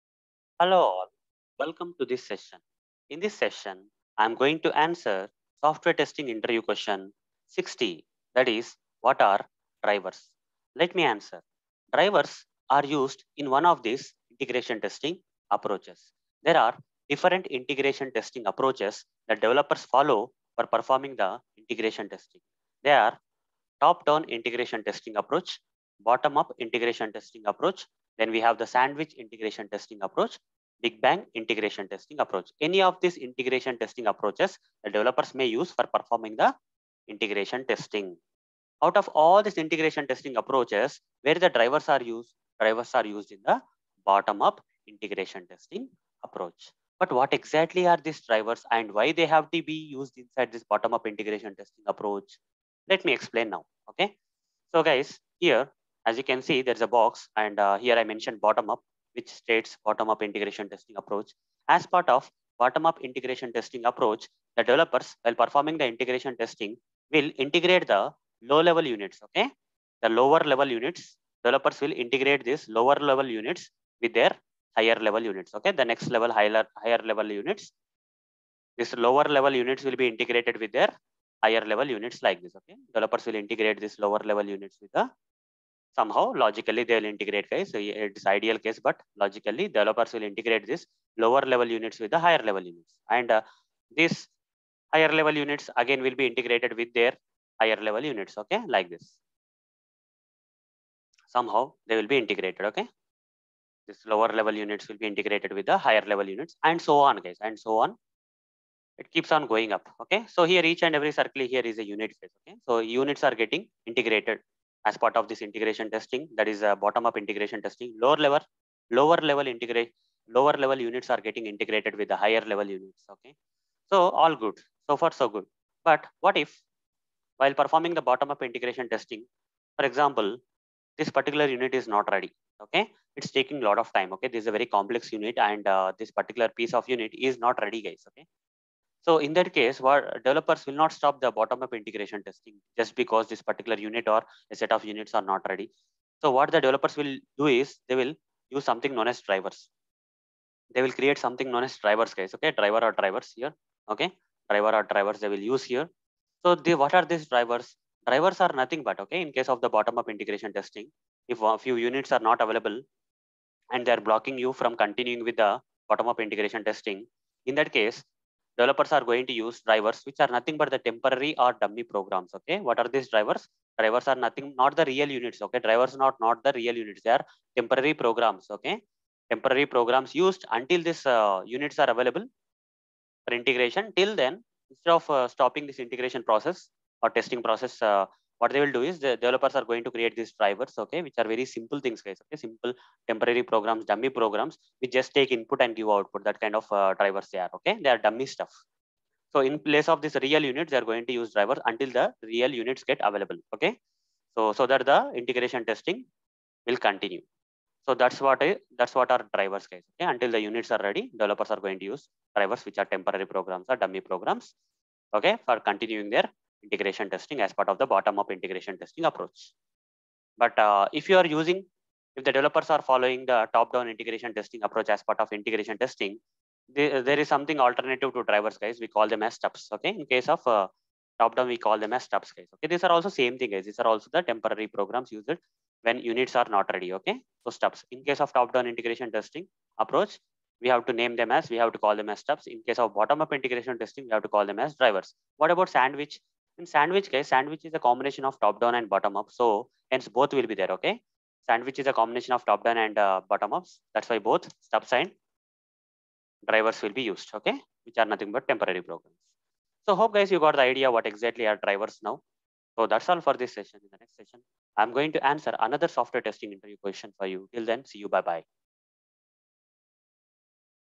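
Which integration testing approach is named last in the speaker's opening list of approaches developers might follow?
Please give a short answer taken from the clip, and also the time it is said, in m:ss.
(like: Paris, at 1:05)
Big Bang, at 0:30.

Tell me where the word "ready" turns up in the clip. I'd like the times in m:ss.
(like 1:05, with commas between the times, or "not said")
2:12, 2:17, 2:25, 3:30, 3:56.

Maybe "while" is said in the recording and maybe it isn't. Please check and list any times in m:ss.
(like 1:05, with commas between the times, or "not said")
1:05, 2:07.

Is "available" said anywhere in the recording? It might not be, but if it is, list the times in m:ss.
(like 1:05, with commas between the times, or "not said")
2:42, 3:01, 3:23.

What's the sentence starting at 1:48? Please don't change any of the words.
It keeps on going up, okay.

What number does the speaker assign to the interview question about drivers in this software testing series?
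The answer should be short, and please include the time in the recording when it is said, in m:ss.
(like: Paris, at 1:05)
60, at 0:07.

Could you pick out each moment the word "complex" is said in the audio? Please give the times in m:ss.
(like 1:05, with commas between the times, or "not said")
2:14.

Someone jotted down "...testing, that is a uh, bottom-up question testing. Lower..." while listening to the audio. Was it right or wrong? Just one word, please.
wrong.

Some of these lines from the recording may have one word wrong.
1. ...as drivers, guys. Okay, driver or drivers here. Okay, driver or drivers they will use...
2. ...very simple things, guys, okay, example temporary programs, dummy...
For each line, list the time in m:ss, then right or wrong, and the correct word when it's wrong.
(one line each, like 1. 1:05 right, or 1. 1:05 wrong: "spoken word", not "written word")
1. 2:31 right
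2. 3:11 wrong: "simple", not "example".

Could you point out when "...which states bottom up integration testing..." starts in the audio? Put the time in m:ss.
0:59.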